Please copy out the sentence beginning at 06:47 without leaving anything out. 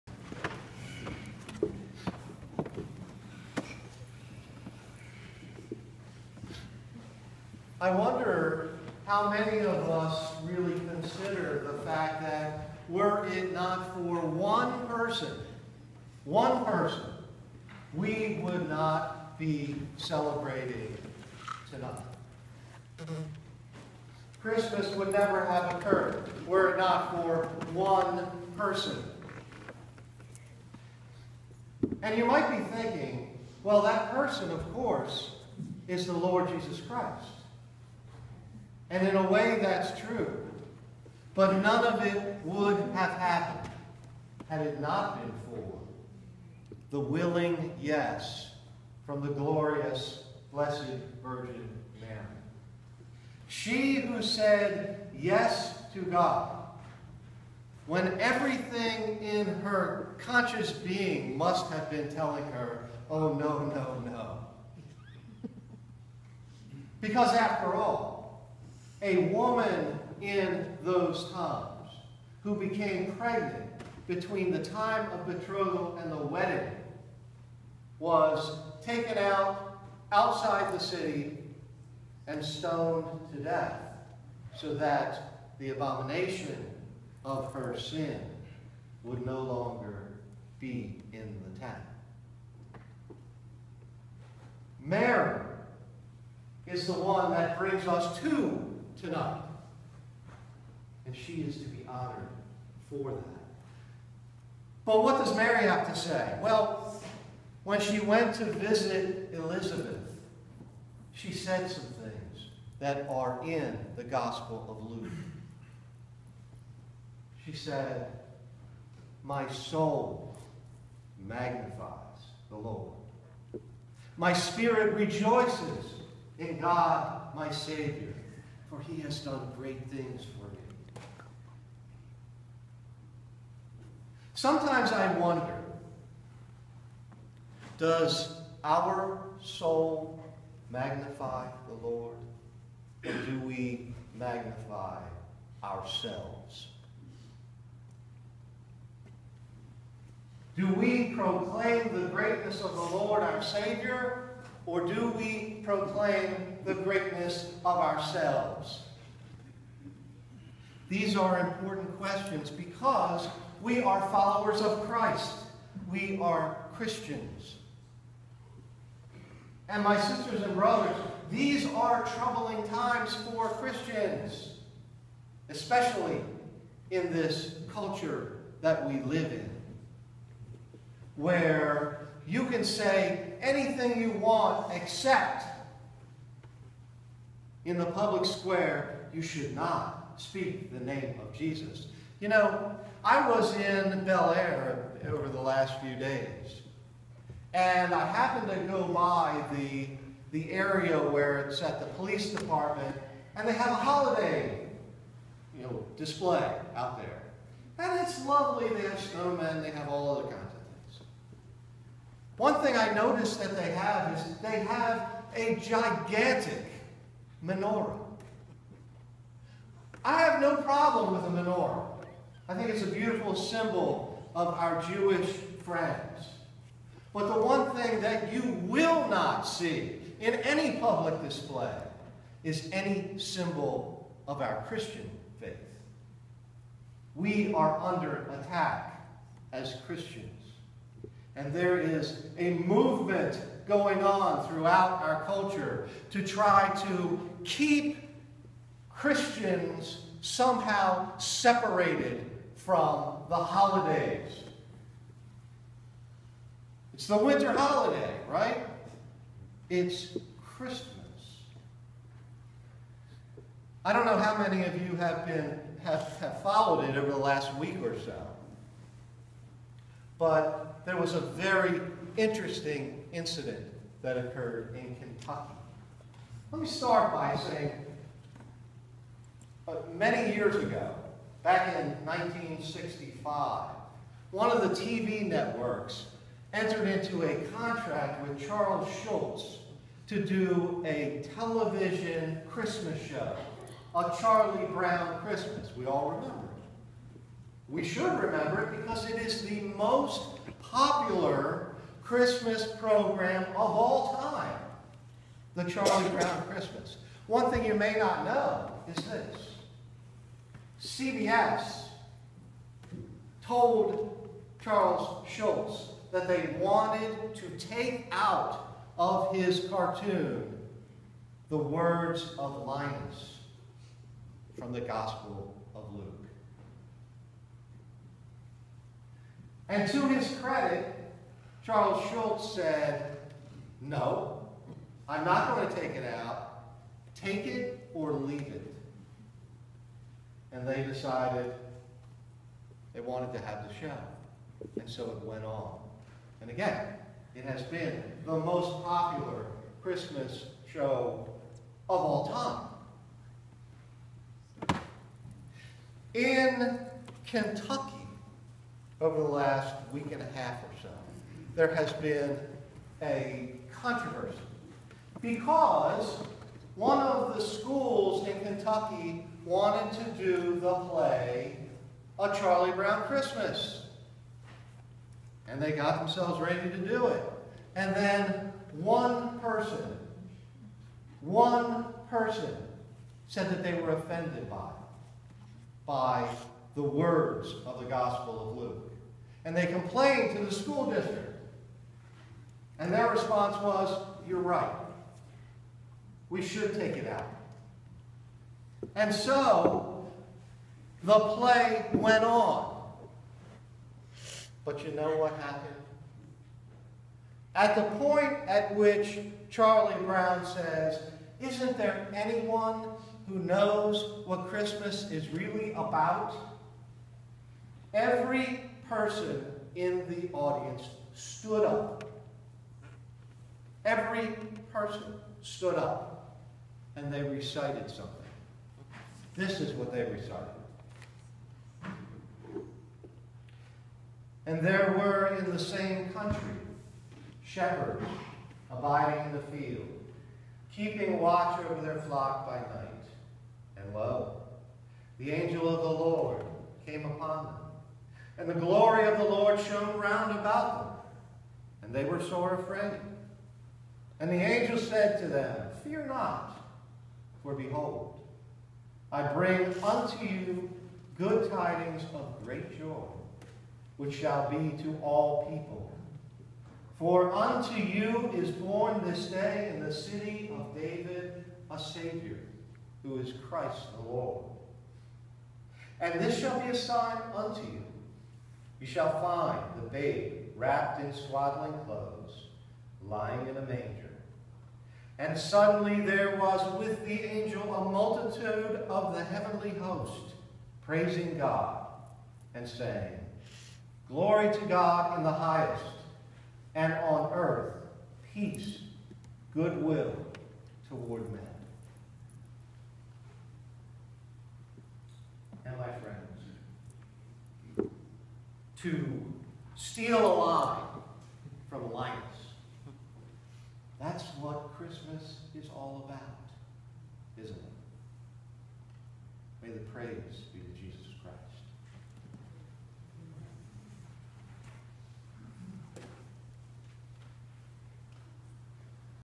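At the point at which Charlie Brown says, isn't there anyone who knows what Christmas is really about?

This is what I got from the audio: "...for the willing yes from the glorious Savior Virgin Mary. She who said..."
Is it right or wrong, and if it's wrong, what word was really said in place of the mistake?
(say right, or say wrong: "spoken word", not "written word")
wrong: "Blessed", not "Savior".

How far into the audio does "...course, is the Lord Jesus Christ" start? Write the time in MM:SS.
00:34.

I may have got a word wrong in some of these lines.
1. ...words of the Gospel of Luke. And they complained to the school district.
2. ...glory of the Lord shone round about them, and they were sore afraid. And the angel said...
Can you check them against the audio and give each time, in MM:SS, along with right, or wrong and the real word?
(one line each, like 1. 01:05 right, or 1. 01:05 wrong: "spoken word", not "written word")
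1. 06:26 right
2. 07:28 right.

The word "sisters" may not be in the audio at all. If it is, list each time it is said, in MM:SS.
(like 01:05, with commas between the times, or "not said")
02:49.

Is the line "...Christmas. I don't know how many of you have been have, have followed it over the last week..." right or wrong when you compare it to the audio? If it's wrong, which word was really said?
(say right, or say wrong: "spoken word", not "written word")
right.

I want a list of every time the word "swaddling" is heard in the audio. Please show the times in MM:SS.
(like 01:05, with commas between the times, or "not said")
08:01.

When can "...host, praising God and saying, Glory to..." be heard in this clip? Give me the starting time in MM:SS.
08:09.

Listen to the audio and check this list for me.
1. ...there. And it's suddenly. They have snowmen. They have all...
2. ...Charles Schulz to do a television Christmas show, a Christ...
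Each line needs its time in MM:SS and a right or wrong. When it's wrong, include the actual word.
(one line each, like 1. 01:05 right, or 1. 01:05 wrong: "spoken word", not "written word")
1. 03:26 wrong: "lovely", not "suddenly"
2. 04:48 wrong: "Charlie", not "Christ".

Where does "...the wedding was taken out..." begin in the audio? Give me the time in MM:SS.
01:16.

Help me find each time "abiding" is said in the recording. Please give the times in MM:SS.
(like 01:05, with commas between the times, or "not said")
07:18.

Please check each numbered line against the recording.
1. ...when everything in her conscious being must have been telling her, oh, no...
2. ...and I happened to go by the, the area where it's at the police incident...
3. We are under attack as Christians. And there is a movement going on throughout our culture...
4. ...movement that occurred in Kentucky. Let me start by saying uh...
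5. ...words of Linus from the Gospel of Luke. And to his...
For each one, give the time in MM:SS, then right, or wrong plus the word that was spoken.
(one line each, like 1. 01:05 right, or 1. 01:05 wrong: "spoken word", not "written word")
1. 00:57 right
2. 03:17 wrong: "department", not "incident"
3. 03:57 right
4. 04:33 wrong: "incident", not "movement"
5. 05:21 right.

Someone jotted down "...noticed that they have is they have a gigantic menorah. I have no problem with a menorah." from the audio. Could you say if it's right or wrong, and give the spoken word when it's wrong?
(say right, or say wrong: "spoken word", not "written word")
right.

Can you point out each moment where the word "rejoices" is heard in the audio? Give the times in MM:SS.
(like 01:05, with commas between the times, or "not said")
02:04.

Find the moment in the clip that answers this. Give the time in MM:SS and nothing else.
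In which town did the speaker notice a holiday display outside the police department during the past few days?
03:14.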